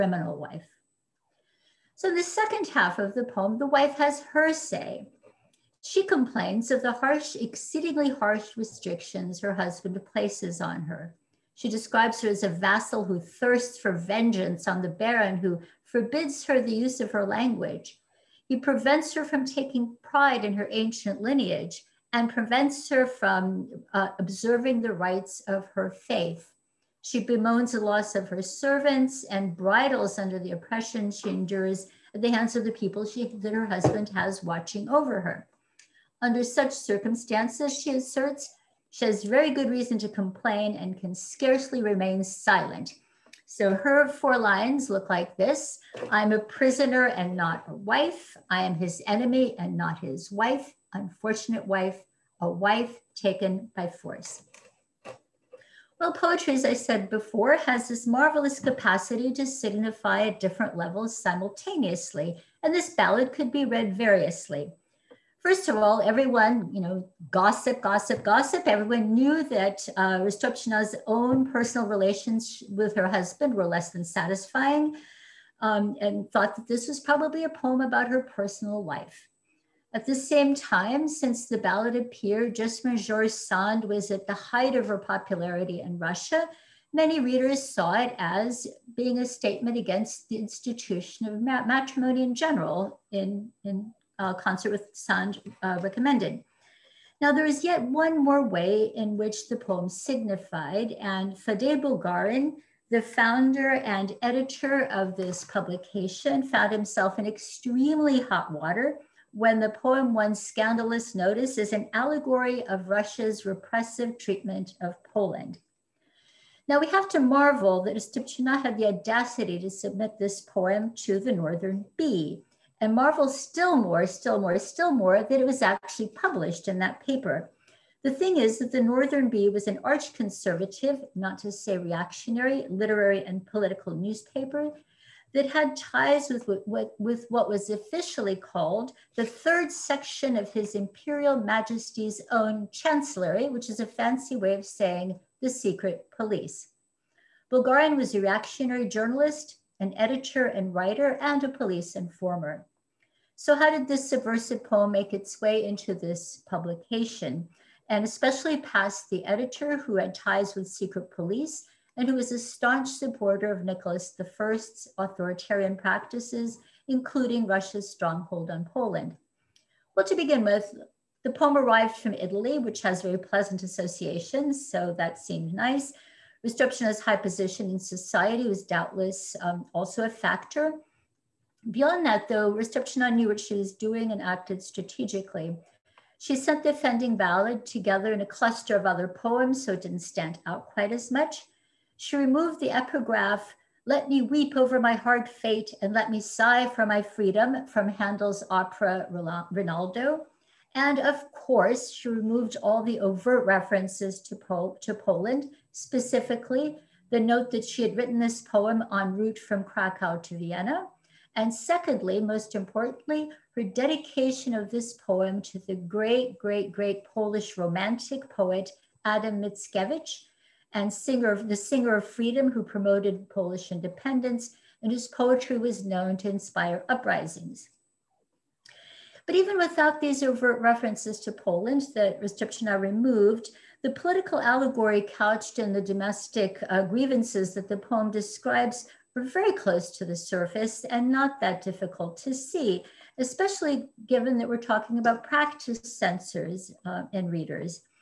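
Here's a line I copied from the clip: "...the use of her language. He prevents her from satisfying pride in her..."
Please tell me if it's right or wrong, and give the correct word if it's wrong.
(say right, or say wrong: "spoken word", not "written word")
wrong: "taking", not "satisfying".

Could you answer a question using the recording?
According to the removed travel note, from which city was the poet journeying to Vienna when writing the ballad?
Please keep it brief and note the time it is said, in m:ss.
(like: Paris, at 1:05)
Krakow, at 3:29.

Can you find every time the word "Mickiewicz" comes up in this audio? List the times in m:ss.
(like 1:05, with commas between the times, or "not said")
3:39.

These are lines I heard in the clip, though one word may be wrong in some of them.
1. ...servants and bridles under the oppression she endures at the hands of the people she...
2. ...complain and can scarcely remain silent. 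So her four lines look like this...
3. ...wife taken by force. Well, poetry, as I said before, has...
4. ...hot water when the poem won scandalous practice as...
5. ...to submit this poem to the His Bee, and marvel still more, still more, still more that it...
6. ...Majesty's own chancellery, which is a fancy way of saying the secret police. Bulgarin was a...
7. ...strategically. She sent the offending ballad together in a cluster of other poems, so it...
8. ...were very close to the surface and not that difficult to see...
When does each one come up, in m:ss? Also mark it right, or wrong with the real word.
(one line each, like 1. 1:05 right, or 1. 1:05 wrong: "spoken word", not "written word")
1. 0:28 right
2. 0:40 right
3. 0:52 right
4. 1:48 wrong: "notice", not "practice"
5. 1:59 wrong: "Northern", not "His"
6. 2:21 right
7. 3:04 right
8. 3:59 right.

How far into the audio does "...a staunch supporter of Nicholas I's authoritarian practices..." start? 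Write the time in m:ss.
2:42.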